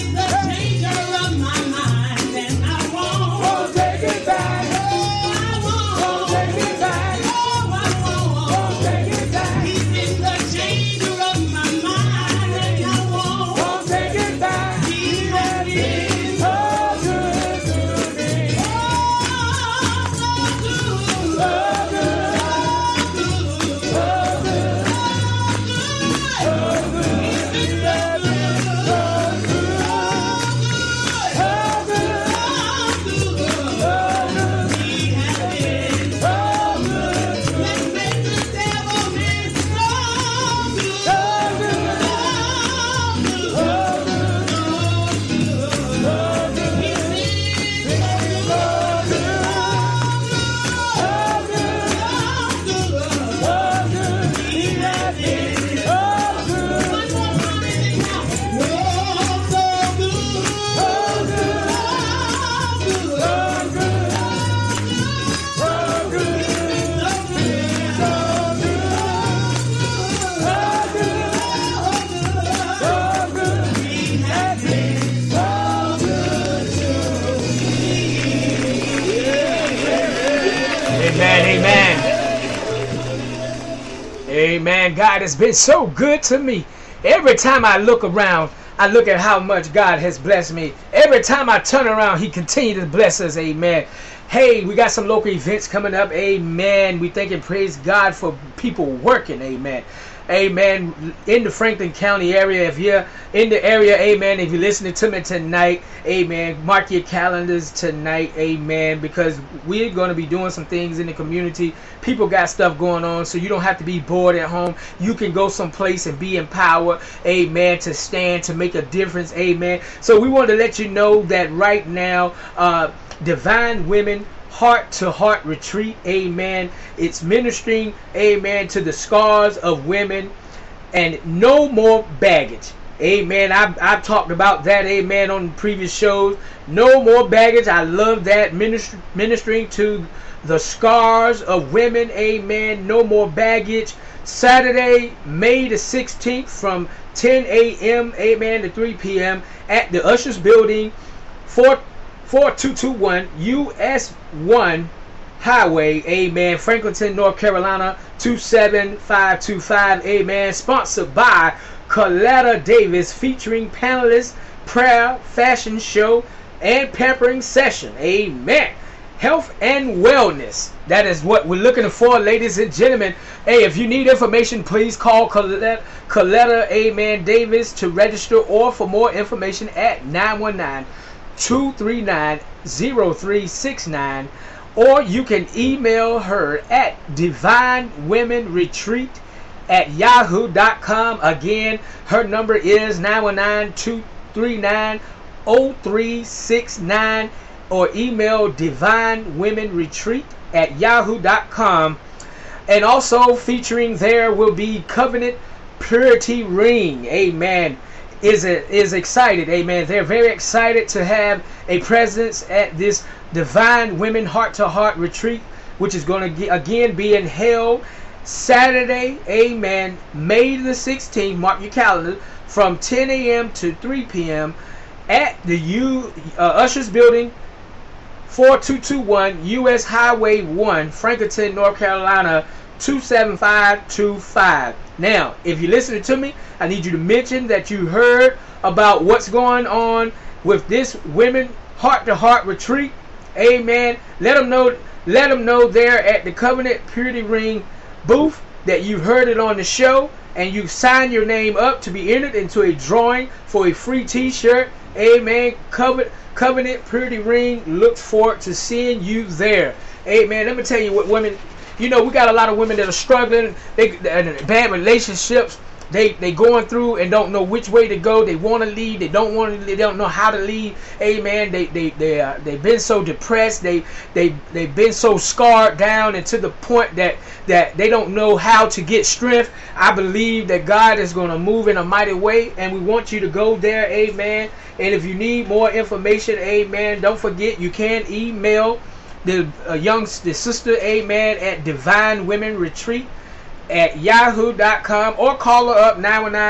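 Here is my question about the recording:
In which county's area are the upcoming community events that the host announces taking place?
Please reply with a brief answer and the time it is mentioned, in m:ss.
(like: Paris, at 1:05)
Franklin County, at 1:41.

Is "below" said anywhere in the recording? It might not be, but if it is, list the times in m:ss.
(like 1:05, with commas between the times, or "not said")
not said.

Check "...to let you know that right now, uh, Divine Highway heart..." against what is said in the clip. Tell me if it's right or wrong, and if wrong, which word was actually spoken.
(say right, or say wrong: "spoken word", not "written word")
wrong: "Women", not "Highway".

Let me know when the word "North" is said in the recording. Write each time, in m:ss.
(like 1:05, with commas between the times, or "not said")
2:37, 3:51.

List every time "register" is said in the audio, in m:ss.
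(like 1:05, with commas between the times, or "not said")
2:57.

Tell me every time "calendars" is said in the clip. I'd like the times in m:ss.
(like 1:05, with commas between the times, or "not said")
1:47, 3:41.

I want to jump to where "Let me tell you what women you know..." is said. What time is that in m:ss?
4:20.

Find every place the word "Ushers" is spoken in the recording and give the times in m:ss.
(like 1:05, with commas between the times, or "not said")
2:30, 3:46.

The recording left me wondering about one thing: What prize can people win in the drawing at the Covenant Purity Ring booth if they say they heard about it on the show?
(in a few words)
Free t-shirt.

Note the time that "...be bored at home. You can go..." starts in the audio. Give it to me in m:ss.
1:53.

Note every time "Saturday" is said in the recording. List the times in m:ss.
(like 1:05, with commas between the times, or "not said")
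2:24, 3:38.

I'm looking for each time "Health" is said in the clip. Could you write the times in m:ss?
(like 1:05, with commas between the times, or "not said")
2:49.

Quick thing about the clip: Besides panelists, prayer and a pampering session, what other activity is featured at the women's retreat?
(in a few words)
Fashion show.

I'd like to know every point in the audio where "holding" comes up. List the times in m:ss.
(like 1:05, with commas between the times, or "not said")
not said.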